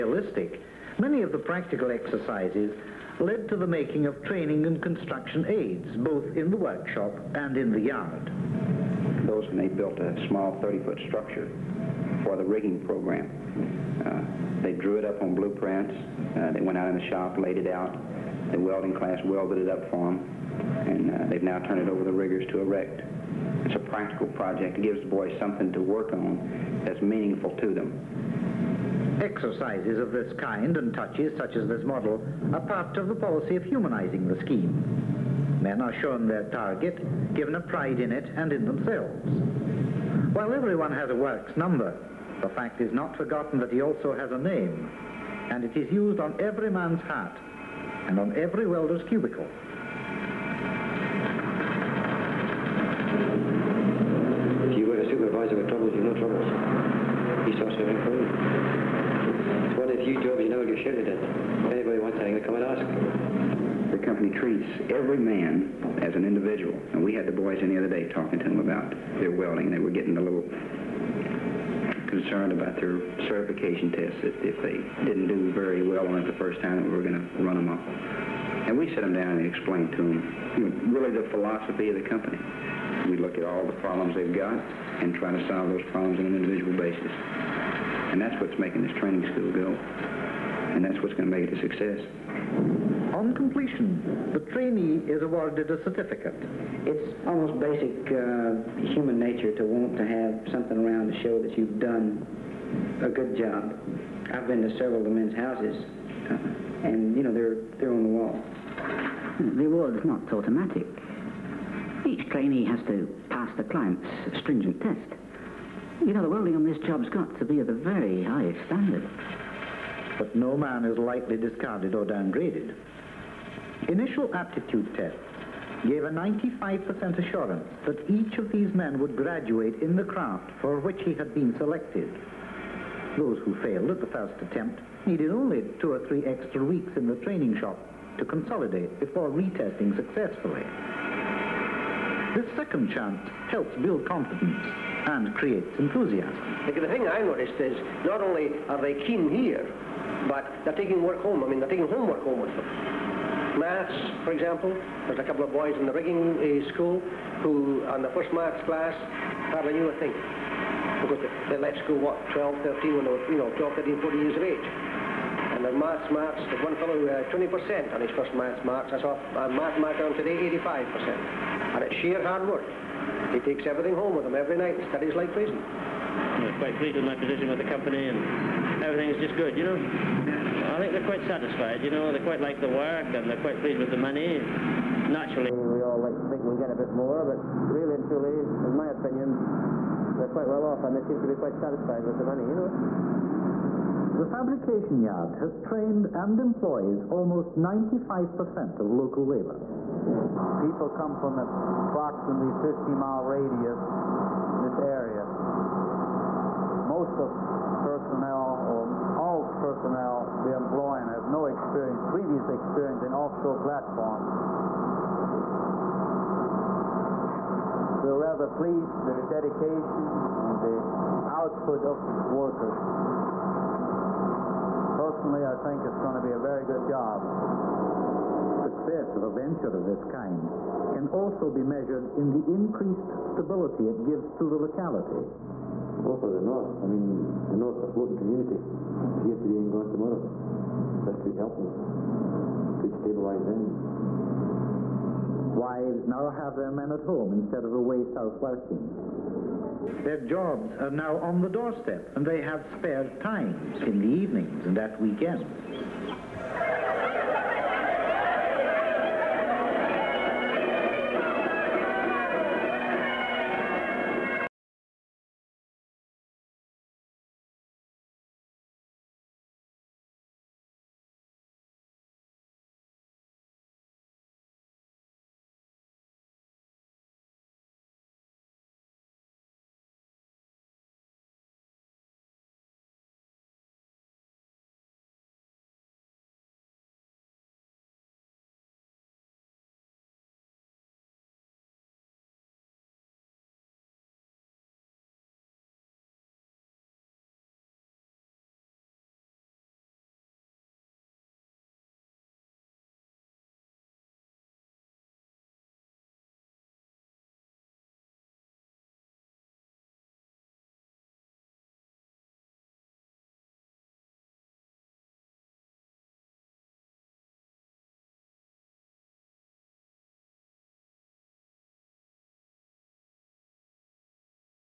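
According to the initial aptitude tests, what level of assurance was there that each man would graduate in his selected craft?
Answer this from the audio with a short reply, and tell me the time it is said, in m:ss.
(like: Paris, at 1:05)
95%, at 2:06.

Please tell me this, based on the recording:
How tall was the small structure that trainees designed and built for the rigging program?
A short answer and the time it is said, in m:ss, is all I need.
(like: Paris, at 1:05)
30 feet, at 0:10.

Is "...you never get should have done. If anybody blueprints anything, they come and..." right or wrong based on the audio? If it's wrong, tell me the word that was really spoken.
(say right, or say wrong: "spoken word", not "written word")
wrong: "wants", not "blueprints".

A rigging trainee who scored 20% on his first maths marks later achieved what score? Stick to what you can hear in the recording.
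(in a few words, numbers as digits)
85%.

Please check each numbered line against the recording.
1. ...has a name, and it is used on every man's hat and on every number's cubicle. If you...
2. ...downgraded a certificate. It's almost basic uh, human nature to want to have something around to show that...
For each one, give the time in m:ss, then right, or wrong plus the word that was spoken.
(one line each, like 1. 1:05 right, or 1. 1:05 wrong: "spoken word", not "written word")
1. 0:44 wrong: "welder", not "number"
2. 1:35 wrong: "awarded", not "downgraded".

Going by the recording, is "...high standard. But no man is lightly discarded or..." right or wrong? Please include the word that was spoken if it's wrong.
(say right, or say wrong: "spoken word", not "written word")
right.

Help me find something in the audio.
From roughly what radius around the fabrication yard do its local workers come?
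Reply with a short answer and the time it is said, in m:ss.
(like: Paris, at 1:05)
50 miles, at 3:22.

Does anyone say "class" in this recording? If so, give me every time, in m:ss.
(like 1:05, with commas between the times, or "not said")
0:18, 2:38.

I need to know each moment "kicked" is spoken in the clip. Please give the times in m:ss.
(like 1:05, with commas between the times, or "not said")
not said.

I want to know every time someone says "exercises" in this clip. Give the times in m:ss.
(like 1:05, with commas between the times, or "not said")
0:01, 0:29.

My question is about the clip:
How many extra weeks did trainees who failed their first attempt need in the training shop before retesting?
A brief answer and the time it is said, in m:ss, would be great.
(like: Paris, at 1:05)
2 or 3 weeks, at 2:15.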